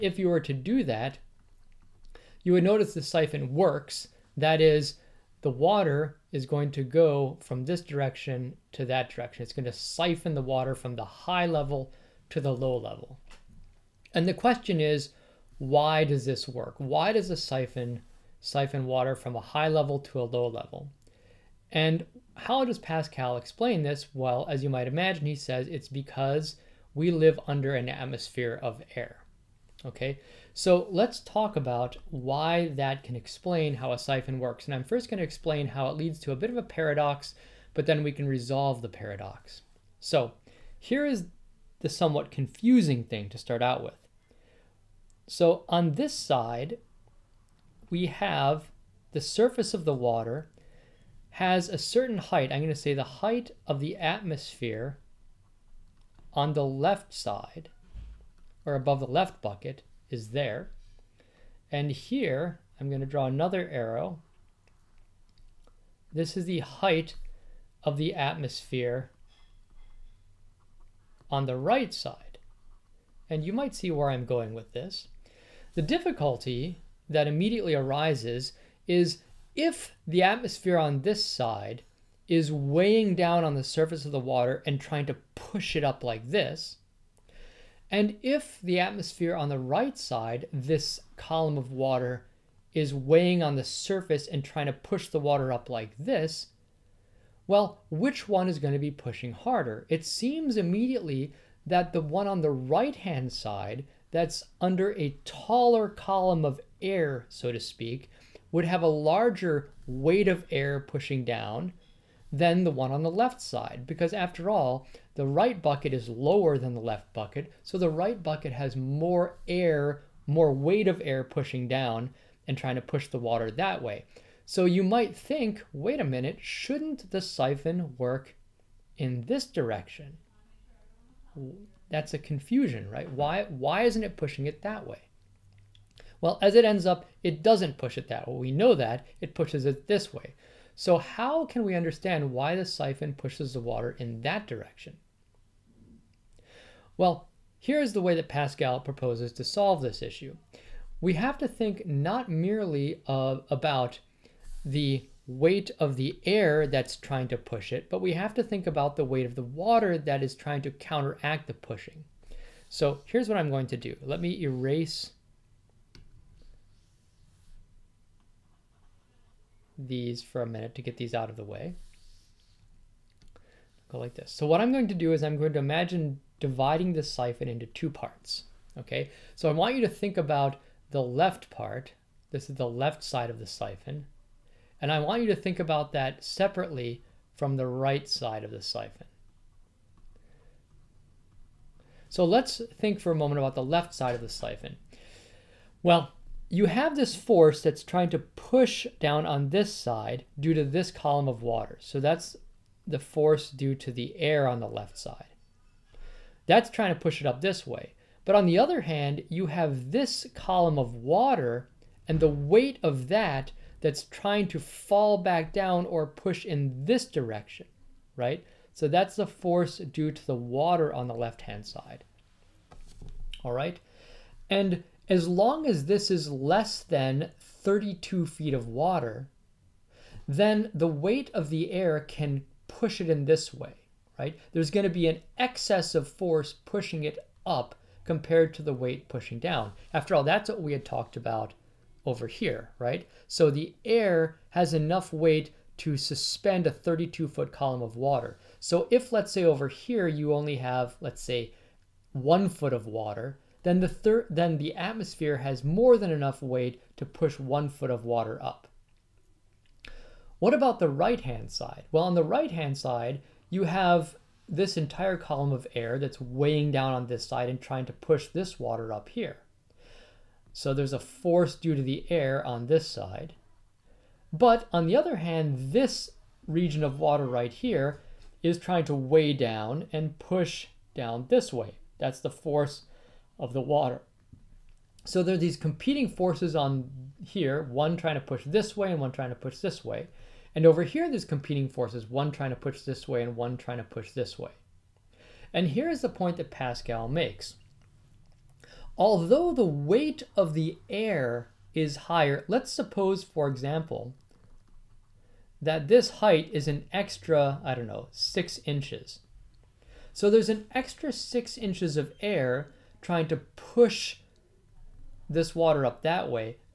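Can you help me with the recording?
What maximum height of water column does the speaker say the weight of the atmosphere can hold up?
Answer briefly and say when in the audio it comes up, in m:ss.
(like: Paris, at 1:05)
32 feet, at 4:06.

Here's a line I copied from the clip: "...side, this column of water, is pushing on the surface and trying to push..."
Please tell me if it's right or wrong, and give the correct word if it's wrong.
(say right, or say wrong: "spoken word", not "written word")
wrong: "weighing", not "pushing".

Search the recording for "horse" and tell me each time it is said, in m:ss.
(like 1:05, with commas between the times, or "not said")
not said.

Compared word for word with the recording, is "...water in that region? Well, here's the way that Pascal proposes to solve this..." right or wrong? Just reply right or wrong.
wrong.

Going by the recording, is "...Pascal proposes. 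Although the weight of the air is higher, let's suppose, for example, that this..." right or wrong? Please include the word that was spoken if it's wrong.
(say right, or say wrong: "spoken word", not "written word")
wrong: "makes", not "proposes".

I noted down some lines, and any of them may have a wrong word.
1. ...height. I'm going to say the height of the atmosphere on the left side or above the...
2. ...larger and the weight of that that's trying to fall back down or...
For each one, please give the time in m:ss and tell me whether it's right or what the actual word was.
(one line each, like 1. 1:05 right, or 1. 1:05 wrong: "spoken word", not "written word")
1. 0:52 right
2. 3:30 wrong: "water", not "larger".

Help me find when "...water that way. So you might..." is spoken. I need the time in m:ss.
2:03.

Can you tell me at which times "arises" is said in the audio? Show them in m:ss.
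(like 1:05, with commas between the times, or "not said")
1:17.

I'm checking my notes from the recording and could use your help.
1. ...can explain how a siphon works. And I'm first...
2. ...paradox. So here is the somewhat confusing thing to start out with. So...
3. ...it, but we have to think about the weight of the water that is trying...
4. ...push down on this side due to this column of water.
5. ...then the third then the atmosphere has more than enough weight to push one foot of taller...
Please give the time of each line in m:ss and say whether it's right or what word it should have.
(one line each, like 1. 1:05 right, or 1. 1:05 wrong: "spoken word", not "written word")
1. 0:33 right
2. 0:38 right
3. 2:37 right
4. 3:18 right
5. 4:13 wrong: "water", not "taller".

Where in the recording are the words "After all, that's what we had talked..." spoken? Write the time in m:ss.
3:59.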